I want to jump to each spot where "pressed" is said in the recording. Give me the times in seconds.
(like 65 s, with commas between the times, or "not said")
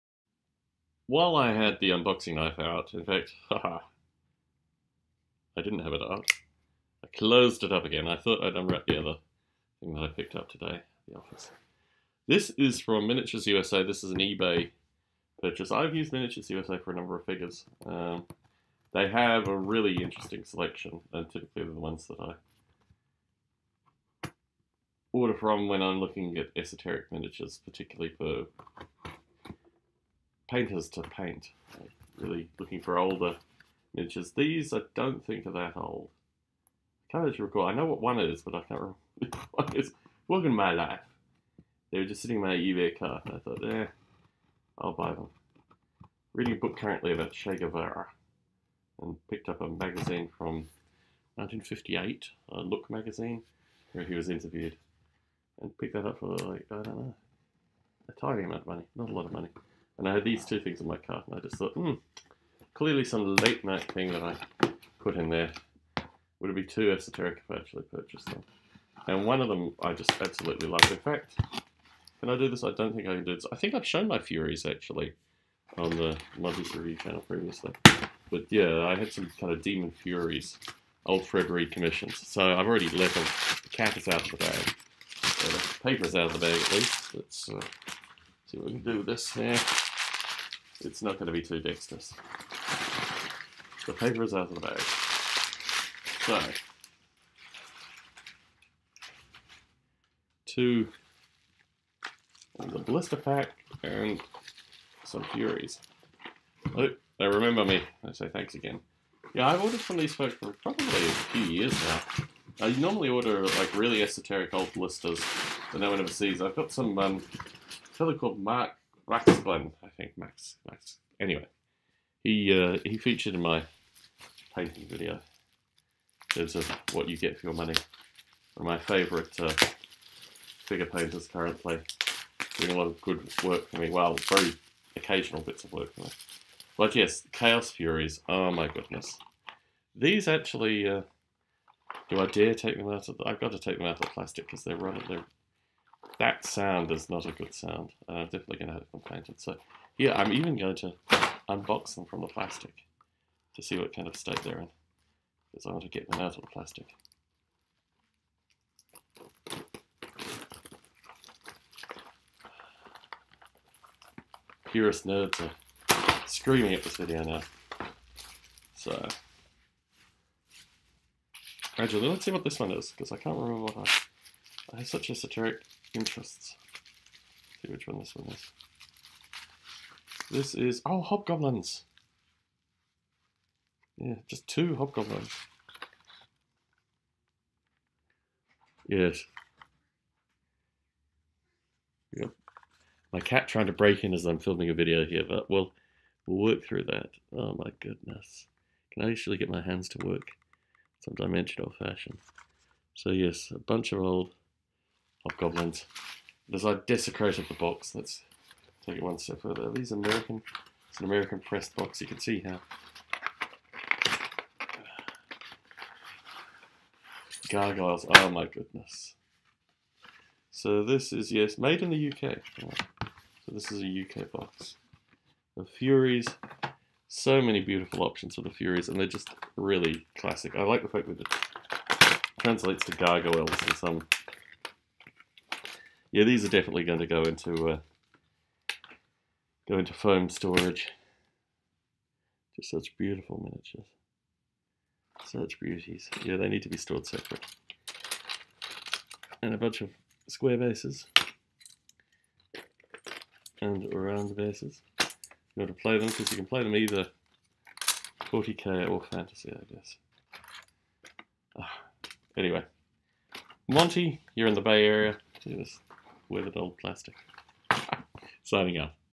211 s.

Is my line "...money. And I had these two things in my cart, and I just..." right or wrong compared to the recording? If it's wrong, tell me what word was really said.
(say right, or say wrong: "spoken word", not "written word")
right.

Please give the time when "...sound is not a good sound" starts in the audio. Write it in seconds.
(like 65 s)
146 s.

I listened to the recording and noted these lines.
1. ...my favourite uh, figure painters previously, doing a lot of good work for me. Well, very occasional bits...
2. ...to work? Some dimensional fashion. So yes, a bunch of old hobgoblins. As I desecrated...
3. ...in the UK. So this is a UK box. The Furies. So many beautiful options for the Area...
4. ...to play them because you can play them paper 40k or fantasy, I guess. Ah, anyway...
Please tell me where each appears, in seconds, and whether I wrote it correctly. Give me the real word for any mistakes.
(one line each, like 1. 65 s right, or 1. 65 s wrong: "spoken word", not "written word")
1. 128 s wrong: "currently", not "previously"
2. 199 s right
3. 221 s wrong: "Furies", not "Area"
4. 255 s wrong: "either", not "paper".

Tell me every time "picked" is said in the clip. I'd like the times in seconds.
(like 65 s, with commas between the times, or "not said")
10 s, 49 s, 55 s.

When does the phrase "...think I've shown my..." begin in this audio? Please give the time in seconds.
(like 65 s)
73 s.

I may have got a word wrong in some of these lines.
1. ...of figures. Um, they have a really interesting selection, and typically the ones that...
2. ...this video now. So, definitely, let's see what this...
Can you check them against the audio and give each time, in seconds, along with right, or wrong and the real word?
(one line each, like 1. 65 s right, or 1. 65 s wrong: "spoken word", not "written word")
1. 17 s right
2. 166 s wrong: "gradually", not "definitely".